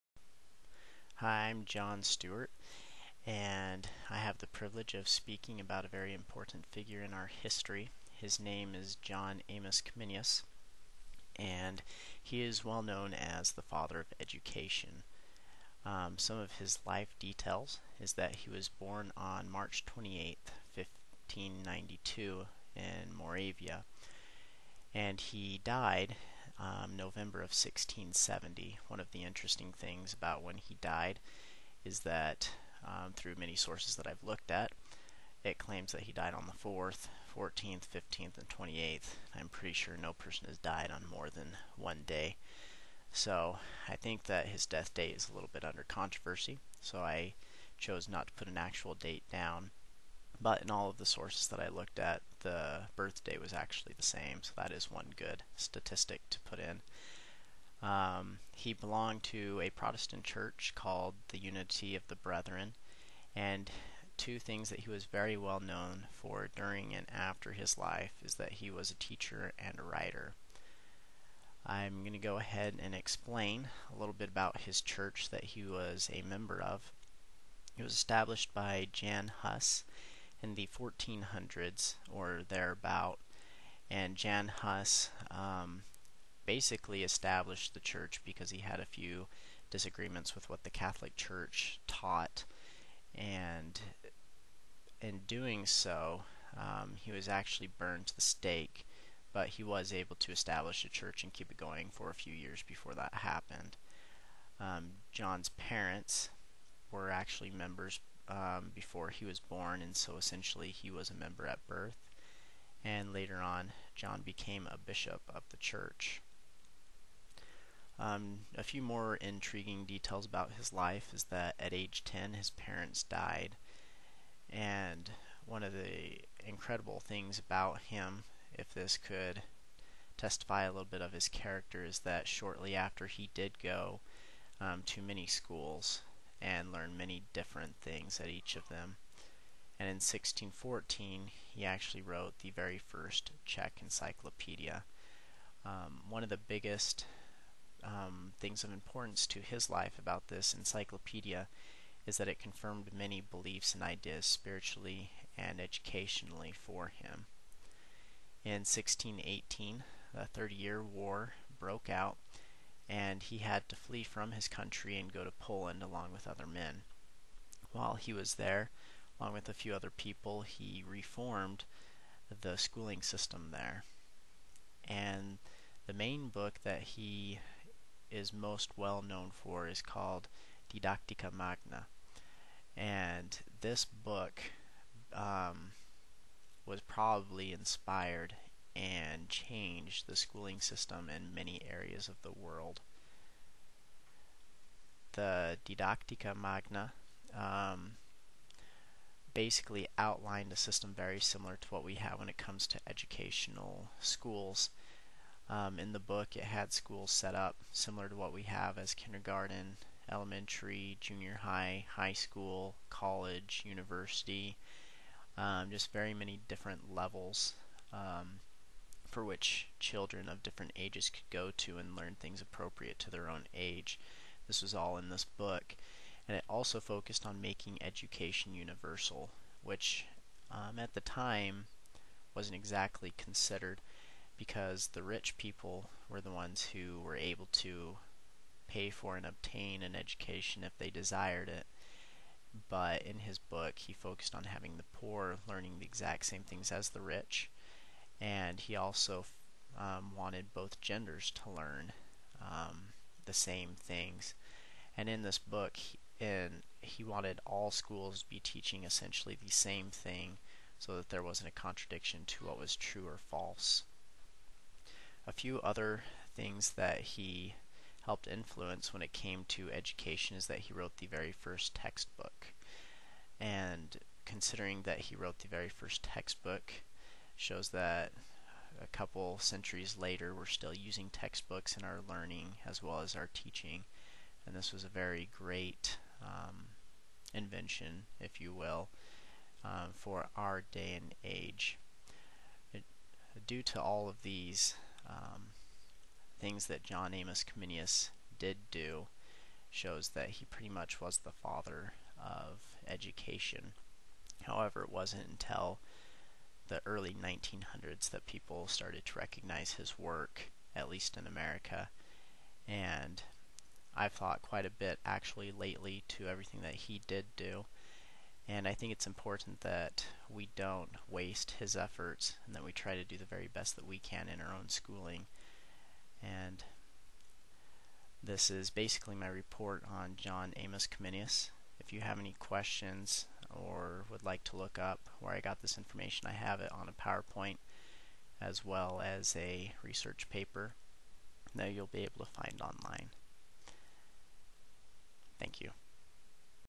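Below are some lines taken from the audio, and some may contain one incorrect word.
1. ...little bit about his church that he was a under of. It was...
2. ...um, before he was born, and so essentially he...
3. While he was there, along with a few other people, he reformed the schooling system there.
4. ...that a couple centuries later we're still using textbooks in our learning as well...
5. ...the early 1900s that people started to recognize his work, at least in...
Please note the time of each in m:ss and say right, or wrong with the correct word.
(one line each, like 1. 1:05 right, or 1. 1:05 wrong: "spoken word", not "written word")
1. 1:13 wrong: "member", not "under"
2. 1:48 right
3. 2:47 right
4. 4:37 right
5. 5:06 right.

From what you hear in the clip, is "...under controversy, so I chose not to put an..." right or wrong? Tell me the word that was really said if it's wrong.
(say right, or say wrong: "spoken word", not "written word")
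right.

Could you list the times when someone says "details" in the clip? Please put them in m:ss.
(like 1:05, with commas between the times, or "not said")
0:17, 1:59.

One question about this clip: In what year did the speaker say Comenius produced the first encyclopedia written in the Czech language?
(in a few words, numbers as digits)
1614.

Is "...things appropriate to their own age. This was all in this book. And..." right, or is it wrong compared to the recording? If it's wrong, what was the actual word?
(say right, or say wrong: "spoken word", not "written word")
right.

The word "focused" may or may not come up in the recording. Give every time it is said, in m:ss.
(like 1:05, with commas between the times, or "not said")
3:46, 4:03.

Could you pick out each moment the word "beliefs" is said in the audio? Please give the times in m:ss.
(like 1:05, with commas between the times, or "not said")
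2:33.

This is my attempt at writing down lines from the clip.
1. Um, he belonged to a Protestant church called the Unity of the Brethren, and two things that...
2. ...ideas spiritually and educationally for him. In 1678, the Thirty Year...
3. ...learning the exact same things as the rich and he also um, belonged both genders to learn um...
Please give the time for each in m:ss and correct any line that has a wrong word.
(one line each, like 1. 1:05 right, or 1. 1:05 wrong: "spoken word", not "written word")
1. 0:57 right
2. 2:33 wrong: "1618", not "1678"
3. 4:05 wrong: "wanted", not "belonged".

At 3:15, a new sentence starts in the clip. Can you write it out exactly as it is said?
The Didactica Magna um, basically outlined a system very similar to what we have when it comes to educational schools.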